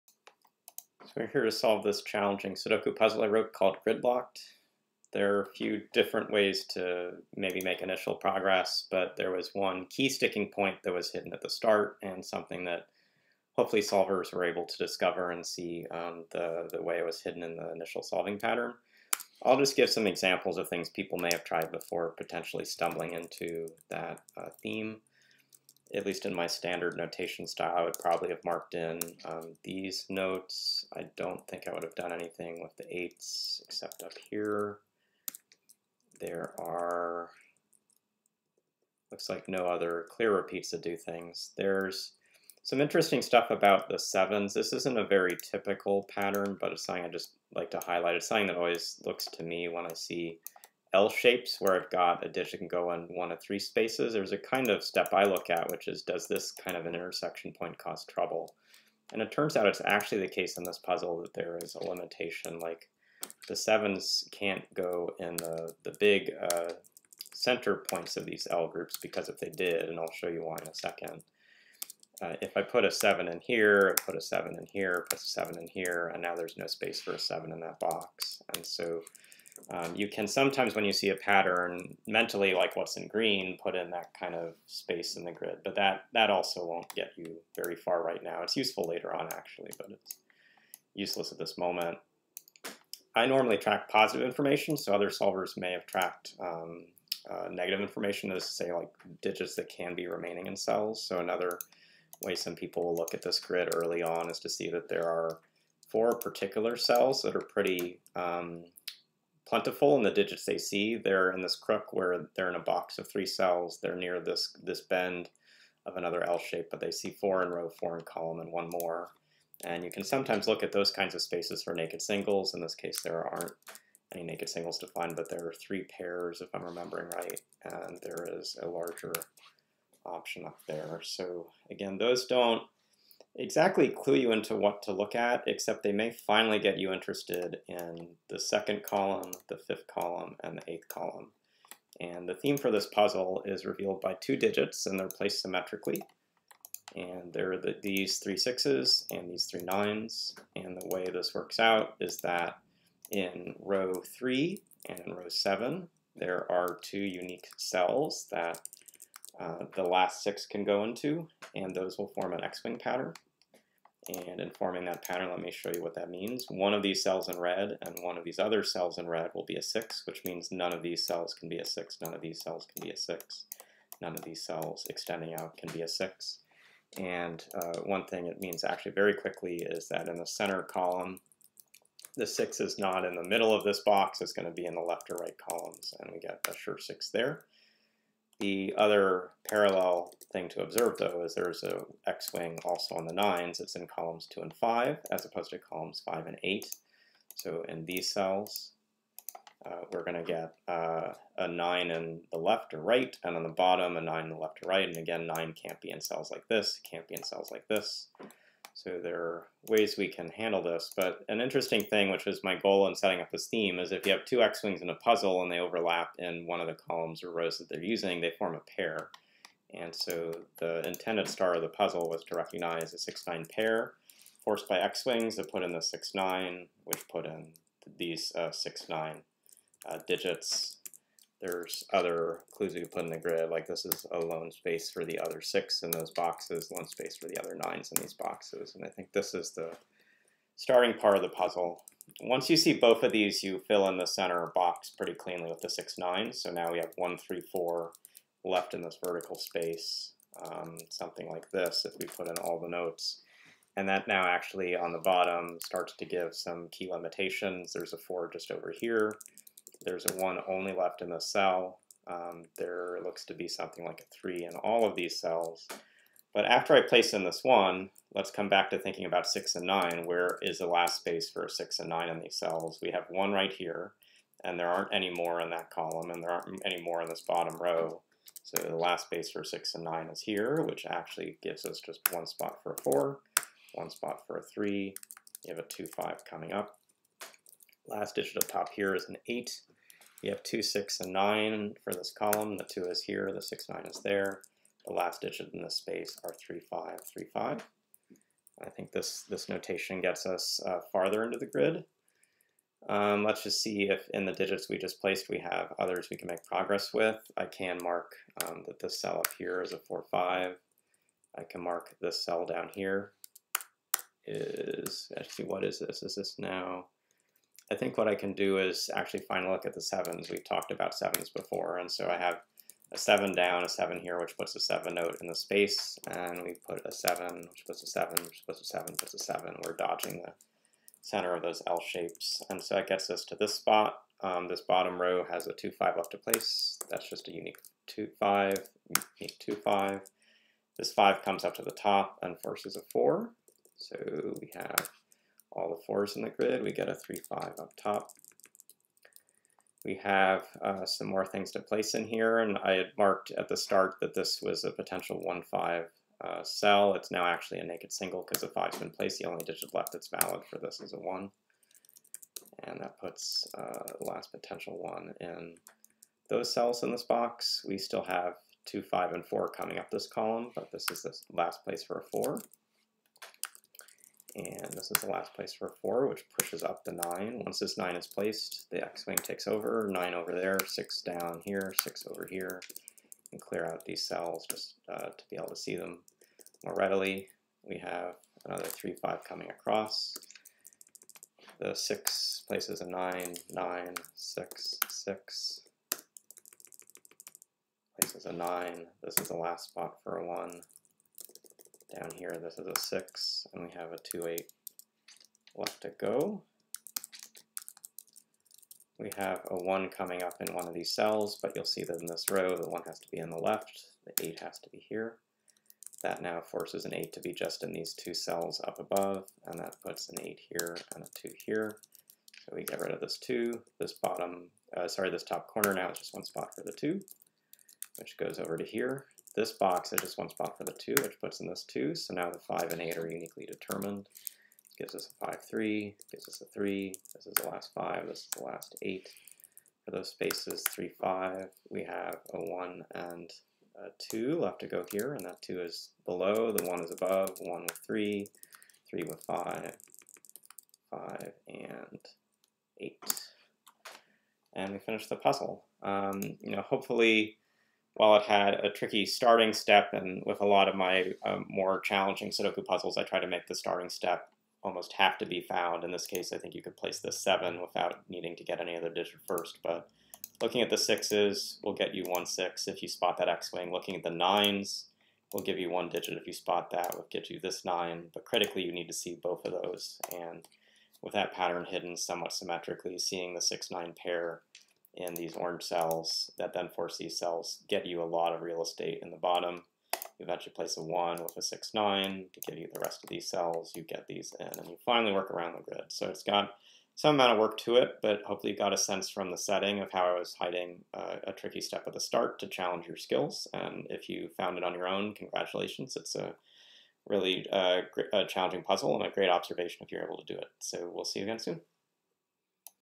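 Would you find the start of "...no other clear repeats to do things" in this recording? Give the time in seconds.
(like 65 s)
39 s.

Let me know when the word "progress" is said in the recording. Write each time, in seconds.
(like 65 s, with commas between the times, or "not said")
8 s, 306 s.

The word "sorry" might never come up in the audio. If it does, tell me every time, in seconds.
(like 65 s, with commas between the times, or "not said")
424 s.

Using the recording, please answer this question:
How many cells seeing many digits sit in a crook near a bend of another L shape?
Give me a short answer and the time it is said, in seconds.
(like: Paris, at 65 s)
4, at 105 s.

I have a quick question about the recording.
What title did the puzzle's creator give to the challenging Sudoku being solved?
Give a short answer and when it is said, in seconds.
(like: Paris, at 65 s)
Gridlocked, at 3 s.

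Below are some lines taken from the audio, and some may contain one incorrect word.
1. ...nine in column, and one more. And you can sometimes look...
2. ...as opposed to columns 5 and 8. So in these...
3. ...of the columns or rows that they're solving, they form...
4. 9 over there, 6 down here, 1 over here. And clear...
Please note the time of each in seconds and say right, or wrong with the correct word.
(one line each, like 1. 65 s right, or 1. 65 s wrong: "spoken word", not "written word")
1. 117 s wrong: "four", not "nine"
2. 195 s right
3. 216 s wrong: "using", not "solving"
4. 379 s wrong: "6", not "1".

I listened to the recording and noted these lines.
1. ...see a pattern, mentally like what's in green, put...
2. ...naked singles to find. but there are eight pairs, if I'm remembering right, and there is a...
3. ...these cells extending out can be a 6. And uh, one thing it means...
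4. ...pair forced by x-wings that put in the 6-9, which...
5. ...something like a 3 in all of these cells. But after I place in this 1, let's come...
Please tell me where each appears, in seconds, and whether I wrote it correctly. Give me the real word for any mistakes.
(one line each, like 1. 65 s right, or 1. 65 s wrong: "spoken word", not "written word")
1. 80 s right
2. 124 s wrong: "three", not "eight"
3. 174 s right
4. 223 s right
5. 263 s right.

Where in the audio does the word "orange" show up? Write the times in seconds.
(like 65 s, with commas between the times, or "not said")
485 s.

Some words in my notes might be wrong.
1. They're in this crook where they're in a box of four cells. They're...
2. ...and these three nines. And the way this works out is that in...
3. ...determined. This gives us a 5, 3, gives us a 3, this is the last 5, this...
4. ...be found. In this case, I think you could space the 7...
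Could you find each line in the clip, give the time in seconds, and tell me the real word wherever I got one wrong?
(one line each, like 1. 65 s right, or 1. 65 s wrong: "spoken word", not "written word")
1. 110 s wrong: "three", not "four"
2. 149 s right
3. 433 s right
4. 465 s wrong: "place", not "space".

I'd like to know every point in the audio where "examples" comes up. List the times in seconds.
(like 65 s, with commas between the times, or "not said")
20 s.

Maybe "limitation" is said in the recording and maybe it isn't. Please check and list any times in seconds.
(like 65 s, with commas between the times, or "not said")
61 s, 256 s.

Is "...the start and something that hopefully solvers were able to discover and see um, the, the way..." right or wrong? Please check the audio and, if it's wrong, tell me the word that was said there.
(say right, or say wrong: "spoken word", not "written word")
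right.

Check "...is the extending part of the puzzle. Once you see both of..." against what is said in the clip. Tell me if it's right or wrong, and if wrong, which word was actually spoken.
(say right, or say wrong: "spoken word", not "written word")
wrong: "starting", not "extending".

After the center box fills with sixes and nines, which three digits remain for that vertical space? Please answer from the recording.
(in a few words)
1, 3, 4.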